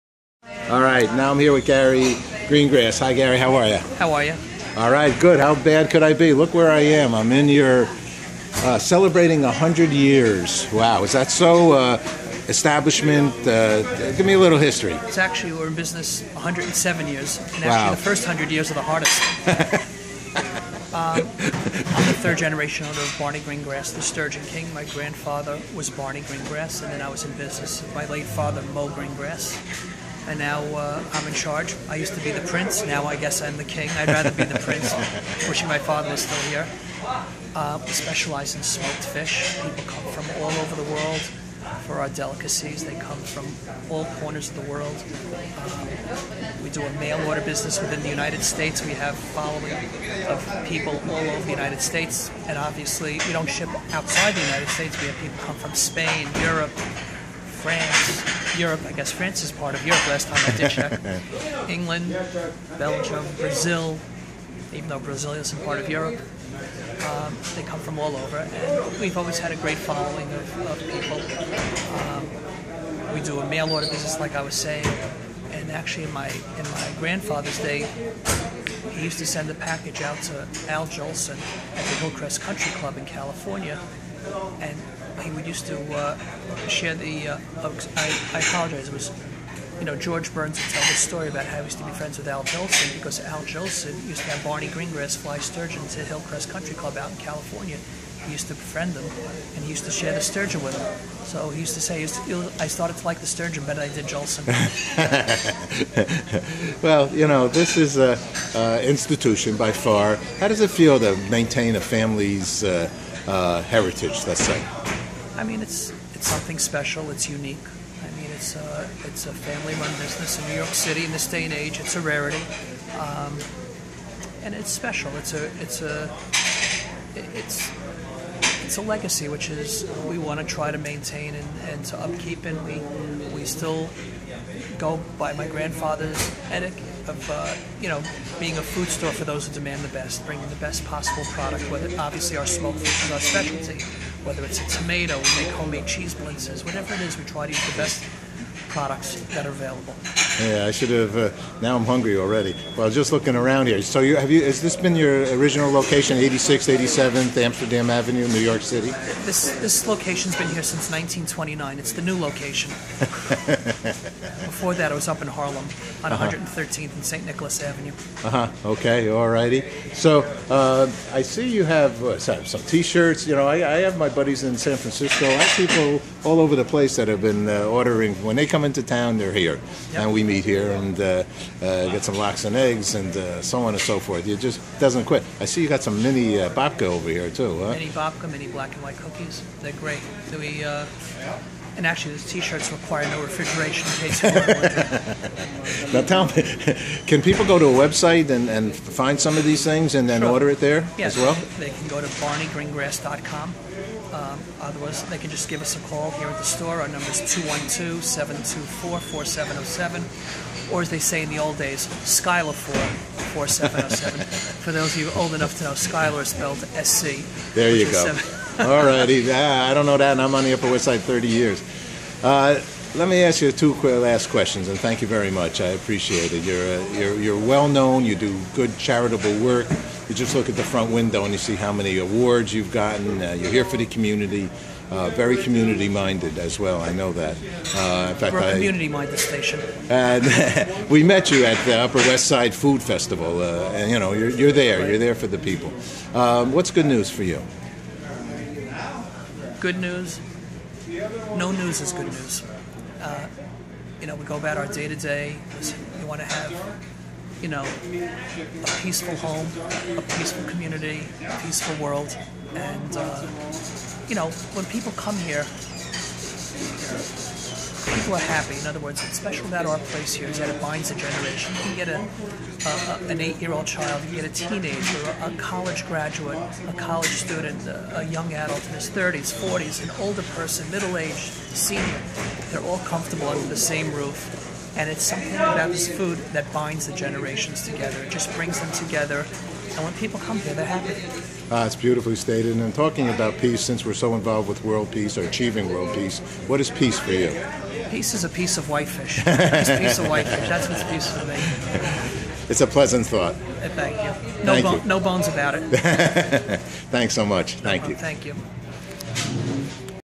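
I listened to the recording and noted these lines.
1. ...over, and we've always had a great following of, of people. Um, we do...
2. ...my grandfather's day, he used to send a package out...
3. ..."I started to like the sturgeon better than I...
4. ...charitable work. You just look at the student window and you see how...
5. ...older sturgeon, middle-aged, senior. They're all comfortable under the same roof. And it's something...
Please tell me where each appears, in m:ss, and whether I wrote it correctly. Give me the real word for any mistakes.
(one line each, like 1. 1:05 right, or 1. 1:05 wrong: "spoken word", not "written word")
1. 1:08 right
2. 1:16 right
3. 1:42 right
4. 3:48 wrong: "front", not "student"
5. 4:40 wrong: "person", not "sturgeon".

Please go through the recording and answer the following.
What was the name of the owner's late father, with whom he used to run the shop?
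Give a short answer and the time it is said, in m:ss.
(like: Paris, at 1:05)
Mo Greengrass, at 0:28.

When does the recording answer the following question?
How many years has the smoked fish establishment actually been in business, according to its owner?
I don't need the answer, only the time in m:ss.
0:16.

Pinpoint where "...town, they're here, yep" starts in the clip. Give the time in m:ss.
2:58.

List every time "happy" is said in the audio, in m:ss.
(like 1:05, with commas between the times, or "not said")
4:28, 4:50.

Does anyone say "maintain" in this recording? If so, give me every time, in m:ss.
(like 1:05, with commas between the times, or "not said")
1:51, 2:10.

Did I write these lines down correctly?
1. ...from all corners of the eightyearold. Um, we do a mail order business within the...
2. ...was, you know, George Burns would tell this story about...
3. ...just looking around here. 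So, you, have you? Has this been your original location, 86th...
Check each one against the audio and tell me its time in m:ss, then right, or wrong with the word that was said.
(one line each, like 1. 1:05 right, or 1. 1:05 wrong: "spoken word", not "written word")
1. 0:43 wrong: "world", not "eightyearold"
2. 1:28 right
3. 2:32 right.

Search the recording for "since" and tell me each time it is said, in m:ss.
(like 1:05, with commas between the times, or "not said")
2:40, 4:53.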